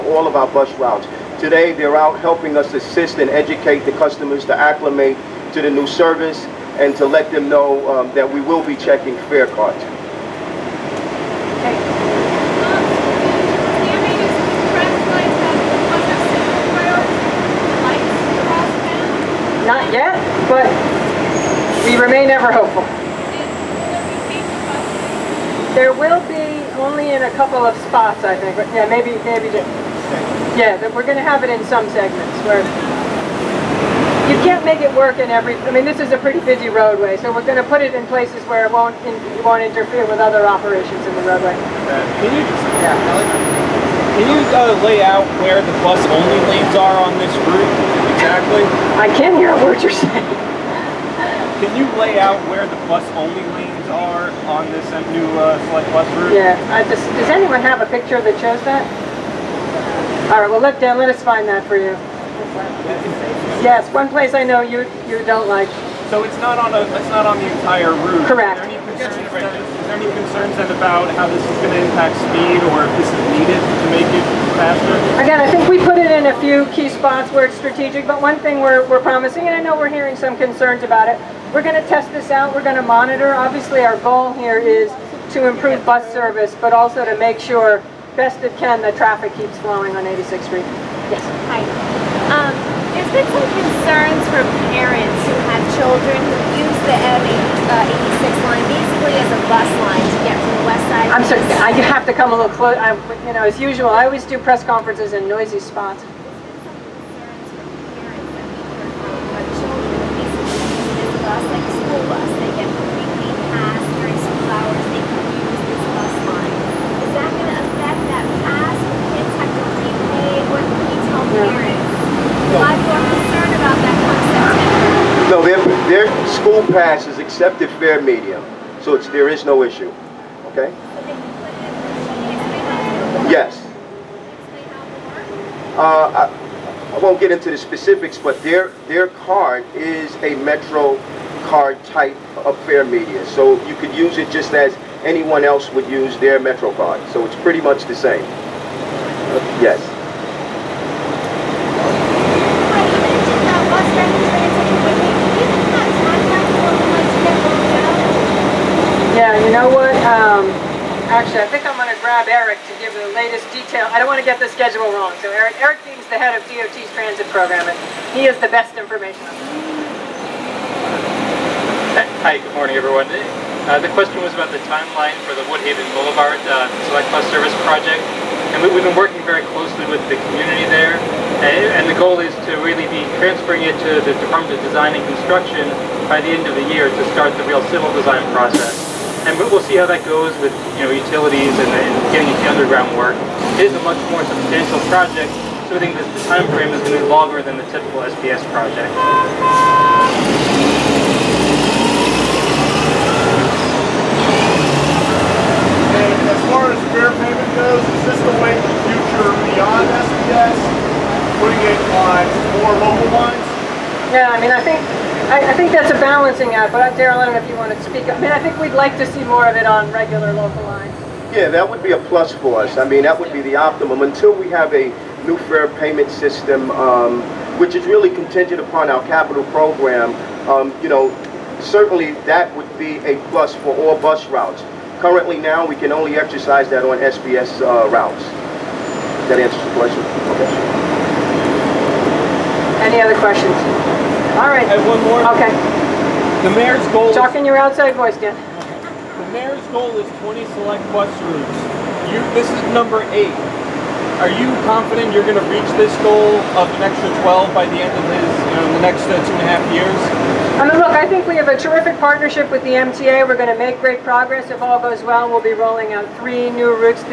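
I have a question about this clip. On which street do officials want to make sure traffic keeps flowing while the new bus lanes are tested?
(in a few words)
86th Street.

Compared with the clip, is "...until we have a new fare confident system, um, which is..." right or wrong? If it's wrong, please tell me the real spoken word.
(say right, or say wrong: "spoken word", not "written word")
wrong: "payment", not "confident".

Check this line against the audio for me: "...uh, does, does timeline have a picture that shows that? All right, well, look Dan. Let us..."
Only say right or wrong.
wrong.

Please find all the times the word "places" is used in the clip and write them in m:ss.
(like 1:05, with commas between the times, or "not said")
0:38, 1:04.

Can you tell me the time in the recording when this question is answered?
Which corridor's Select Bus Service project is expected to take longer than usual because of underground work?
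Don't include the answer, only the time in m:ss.
2:55.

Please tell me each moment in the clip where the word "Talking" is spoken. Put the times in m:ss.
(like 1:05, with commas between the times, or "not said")
4:07.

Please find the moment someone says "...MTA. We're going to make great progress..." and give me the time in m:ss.
4:22.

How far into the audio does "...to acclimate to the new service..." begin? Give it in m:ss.
0:04.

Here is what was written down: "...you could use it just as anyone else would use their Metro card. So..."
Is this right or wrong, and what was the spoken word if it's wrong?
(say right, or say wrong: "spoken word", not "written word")
right.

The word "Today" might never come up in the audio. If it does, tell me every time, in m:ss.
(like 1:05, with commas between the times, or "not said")
0:01.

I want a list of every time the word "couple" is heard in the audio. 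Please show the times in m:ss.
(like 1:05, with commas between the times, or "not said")
0:27.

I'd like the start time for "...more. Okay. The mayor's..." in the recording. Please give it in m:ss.
4:05.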